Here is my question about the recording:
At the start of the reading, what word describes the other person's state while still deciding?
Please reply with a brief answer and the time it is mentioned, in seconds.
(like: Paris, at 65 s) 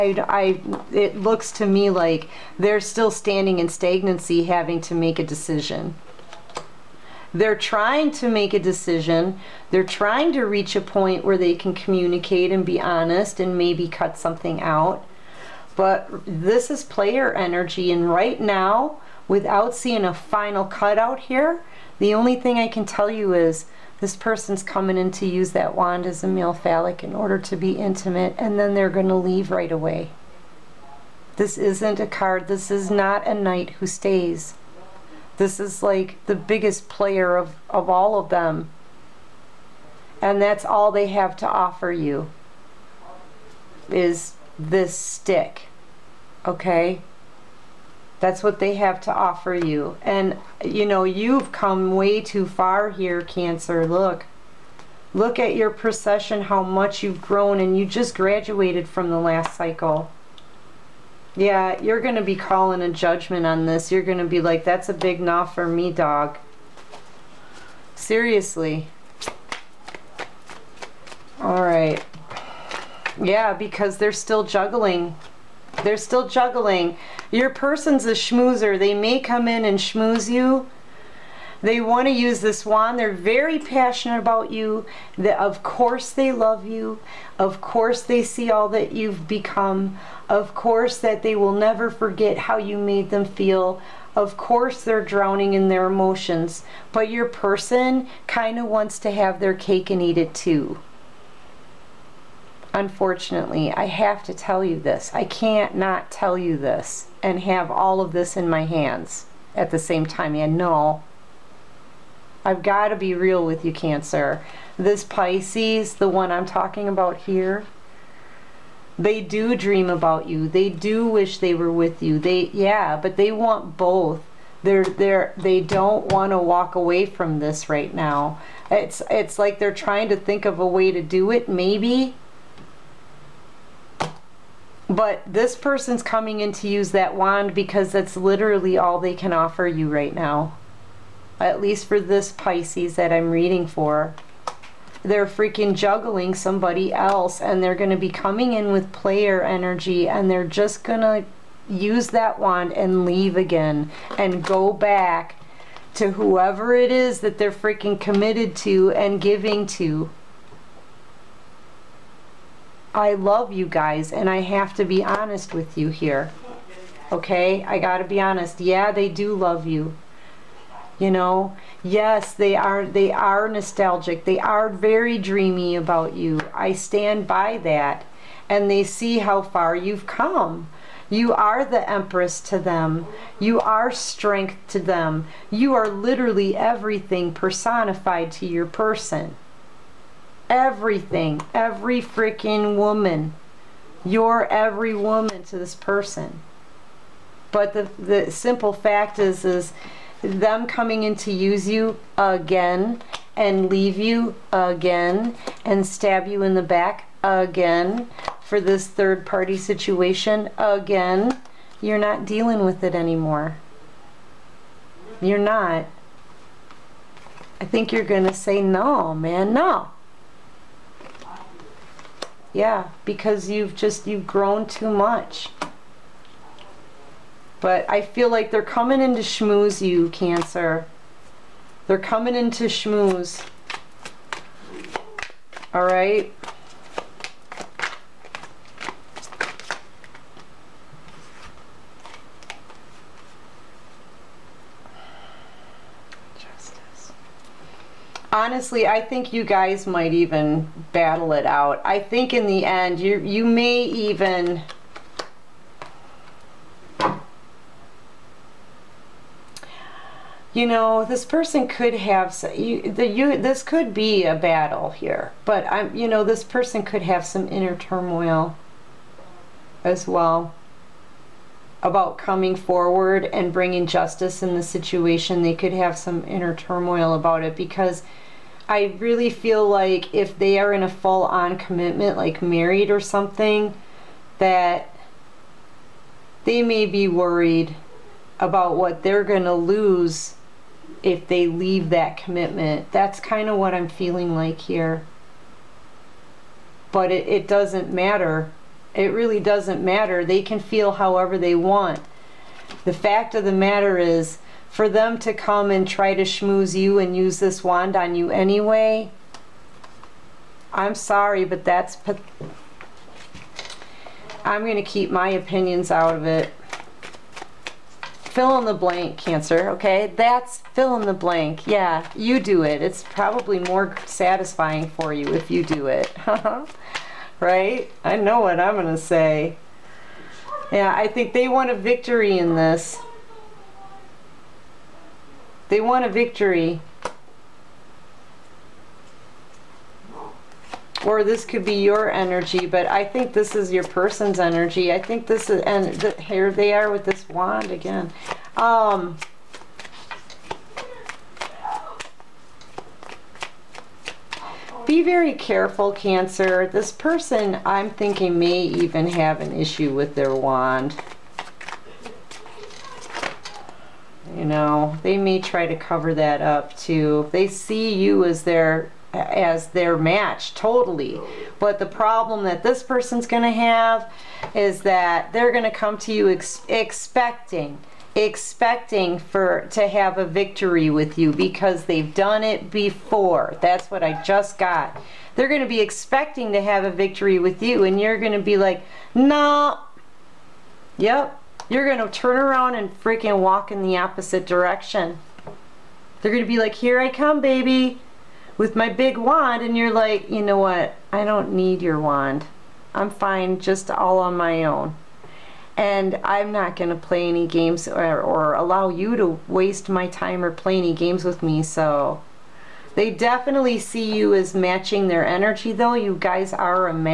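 stagnancy, at 3 s.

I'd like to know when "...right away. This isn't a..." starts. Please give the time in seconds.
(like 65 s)
29 s.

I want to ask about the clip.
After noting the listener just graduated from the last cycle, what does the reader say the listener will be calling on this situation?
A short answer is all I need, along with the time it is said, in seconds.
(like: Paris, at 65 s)
judgment, at 62 s.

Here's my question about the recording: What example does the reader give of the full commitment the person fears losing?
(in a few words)
married.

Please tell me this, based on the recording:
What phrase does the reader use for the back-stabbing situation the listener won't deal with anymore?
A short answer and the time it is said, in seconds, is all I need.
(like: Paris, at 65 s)
third party situation, at 208 s.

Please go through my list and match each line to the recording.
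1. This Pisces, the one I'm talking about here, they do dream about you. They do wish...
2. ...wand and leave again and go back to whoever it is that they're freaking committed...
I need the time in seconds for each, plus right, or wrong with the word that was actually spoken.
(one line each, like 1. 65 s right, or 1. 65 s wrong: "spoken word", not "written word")
1. 114 s right
2. 152 s right.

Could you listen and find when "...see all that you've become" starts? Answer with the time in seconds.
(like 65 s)
88 s.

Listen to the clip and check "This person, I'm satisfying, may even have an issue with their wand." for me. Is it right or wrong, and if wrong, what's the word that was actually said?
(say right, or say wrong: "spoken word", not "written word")
wrong: "thinking", not "satisfying".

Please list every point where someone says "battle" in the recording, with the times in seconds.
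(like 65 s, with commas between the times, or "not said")
250 s, 264 s.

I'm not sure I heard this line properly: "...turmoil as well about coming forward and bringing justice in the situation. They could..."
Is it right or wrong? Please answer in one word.
right.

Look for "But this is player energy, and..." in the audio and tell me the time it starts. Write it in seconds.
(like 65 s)
15 s.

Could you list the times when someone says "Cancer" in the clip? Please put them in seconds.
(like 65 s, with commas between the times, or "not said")
53 s, 113 s, 230 s, 319 s, 355 s.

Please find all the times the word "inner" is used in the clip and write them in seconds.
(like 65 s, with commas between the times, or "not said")
267 s, 276 s.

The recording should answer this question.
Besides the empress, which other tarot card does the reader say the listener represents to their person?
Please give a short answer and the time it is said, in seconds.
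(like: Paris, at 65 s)
strength, at 183 s.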